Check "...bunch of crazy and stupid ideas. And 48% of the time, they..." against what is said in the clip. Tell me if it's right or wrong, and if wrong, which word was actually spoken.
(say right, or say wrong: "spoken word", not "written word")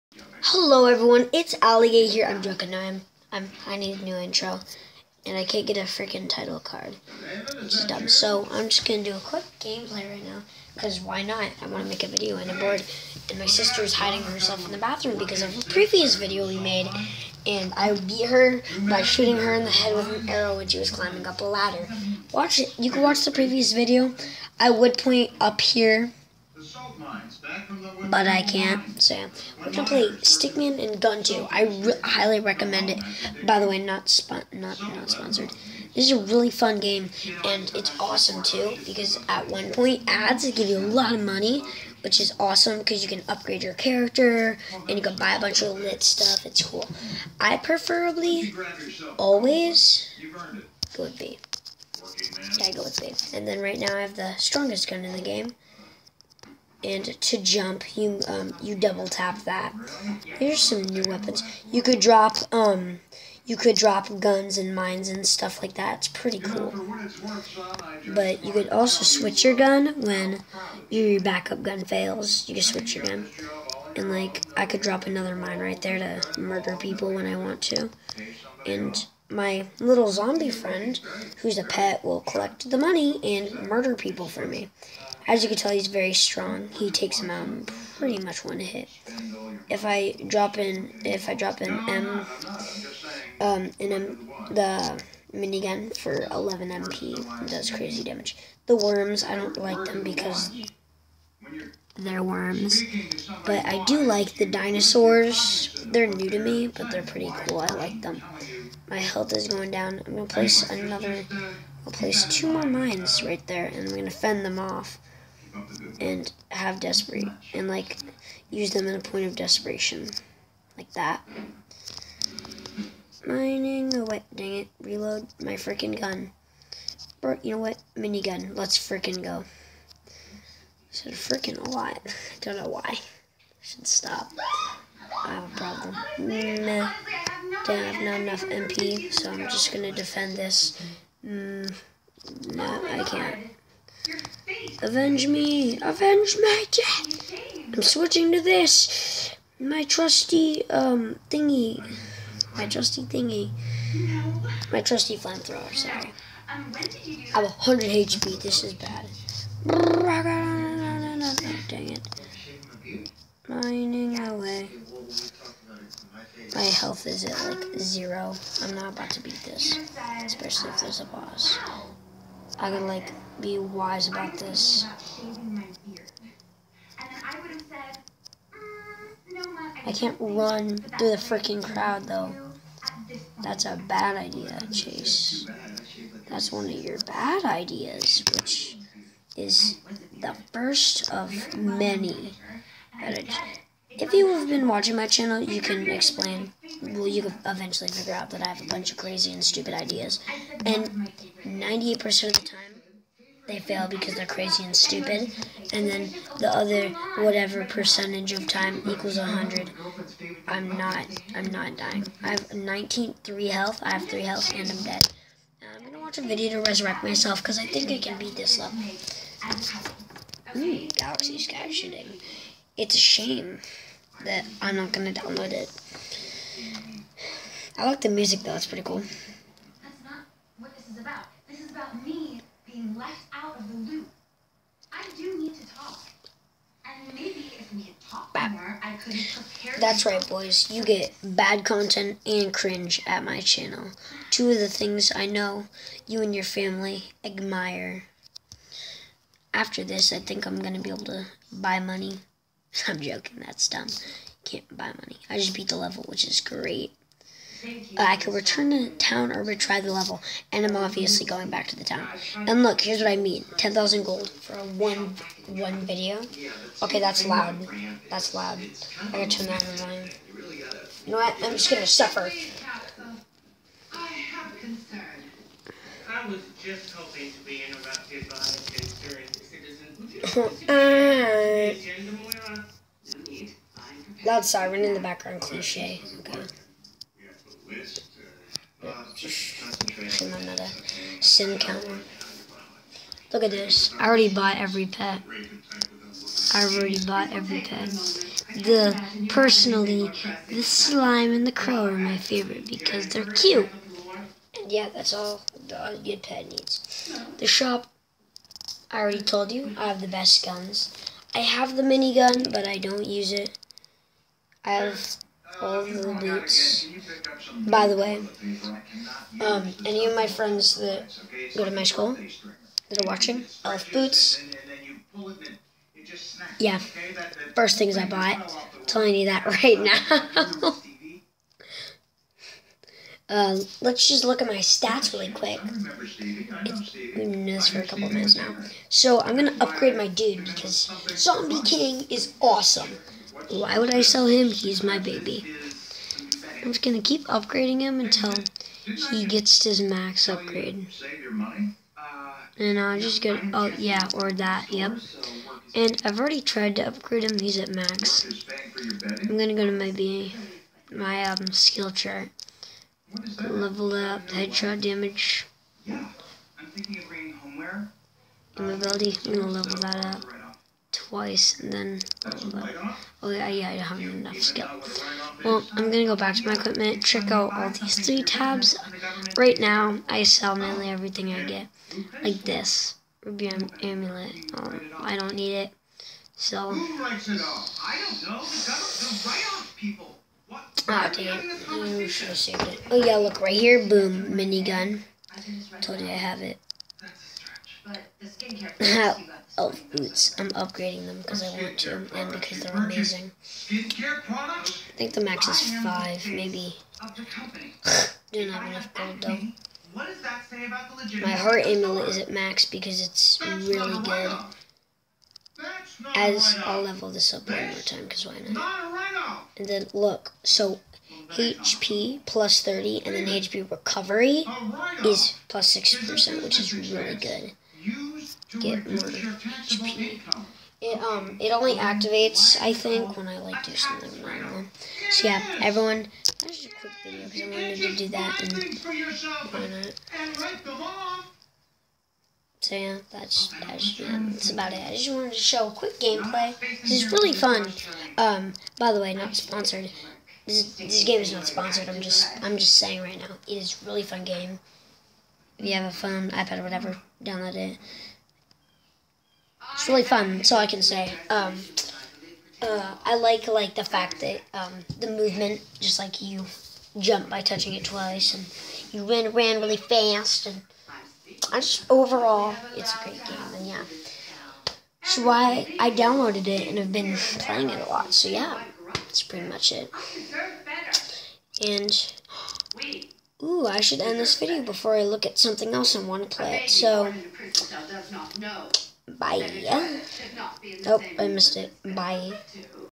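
wrong: "98", not "48".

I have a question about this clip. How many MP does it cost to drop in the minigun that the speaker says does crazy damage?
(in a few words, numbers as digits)
11.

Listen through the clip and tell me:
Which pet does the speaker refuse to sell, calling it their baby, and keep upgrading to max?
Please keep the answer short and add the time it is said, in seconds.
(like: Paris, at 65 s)
Zombie King, at 341 s.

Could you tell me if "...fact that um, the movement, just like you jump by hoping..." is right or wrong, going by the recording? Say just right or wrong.
wrong.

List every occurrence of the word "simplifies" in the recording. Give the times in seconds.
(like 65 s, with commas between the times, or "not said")
not said.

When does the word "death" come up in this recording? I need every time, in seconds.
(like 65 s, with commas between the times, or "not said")
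146 s.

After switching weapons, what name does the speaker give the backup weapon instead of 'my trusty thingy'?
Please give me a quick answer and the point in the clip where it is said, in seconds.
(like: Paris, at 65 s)
flamethrower, at 155 s.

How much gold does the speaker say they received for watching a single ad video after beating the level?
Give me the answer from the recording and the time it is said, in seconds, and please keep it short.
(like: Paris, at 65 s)
10,000, at 263 s.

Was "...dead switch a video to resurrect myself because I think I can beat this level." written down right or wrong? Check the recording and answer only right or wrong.
wrong.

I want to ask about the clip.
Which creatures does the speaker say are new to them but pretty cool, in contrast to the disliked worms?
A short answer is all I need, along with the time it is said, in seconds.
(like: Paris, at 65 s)
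dinosaurs, at 104 s.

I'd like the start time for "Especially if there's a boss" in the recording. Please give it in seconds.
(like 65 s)
170 s.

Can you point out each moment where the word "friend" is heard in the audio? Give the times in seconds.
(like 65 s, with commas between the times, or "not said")
80 s, 320 s.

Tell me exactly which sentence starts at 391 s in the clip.
I should ah, have saved it.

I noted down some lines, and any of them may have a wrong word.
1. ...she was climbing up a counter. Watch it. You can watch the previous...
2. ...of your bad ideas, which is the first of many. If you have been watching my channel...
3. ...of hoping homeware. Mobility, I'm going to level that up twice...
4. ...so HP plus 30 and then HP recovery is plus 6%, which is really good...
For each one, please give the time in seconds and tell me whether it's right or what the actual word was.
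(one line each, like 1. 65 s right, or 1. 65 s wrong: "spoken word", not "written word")
1. 20 s wrong: "ladder", not "counter"
2. 186 s right
3. 366 s wrong: "bringing", not "hoping"
4. 420 s right.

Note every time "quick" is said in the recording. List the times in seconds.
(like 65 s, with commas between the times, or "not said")
9 s, 335 s, 436 s, 445 s.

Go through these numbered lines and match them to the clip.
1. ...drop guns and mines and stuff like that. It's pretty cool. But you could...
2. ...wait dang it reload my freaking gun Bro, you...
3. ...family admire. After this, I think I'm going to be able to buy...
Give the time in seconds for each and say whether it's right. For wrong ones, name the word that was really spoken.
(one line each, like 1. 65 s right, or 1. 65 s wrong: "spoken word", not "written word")
1. 63 s right
2. 124 s right
3. 246 s right.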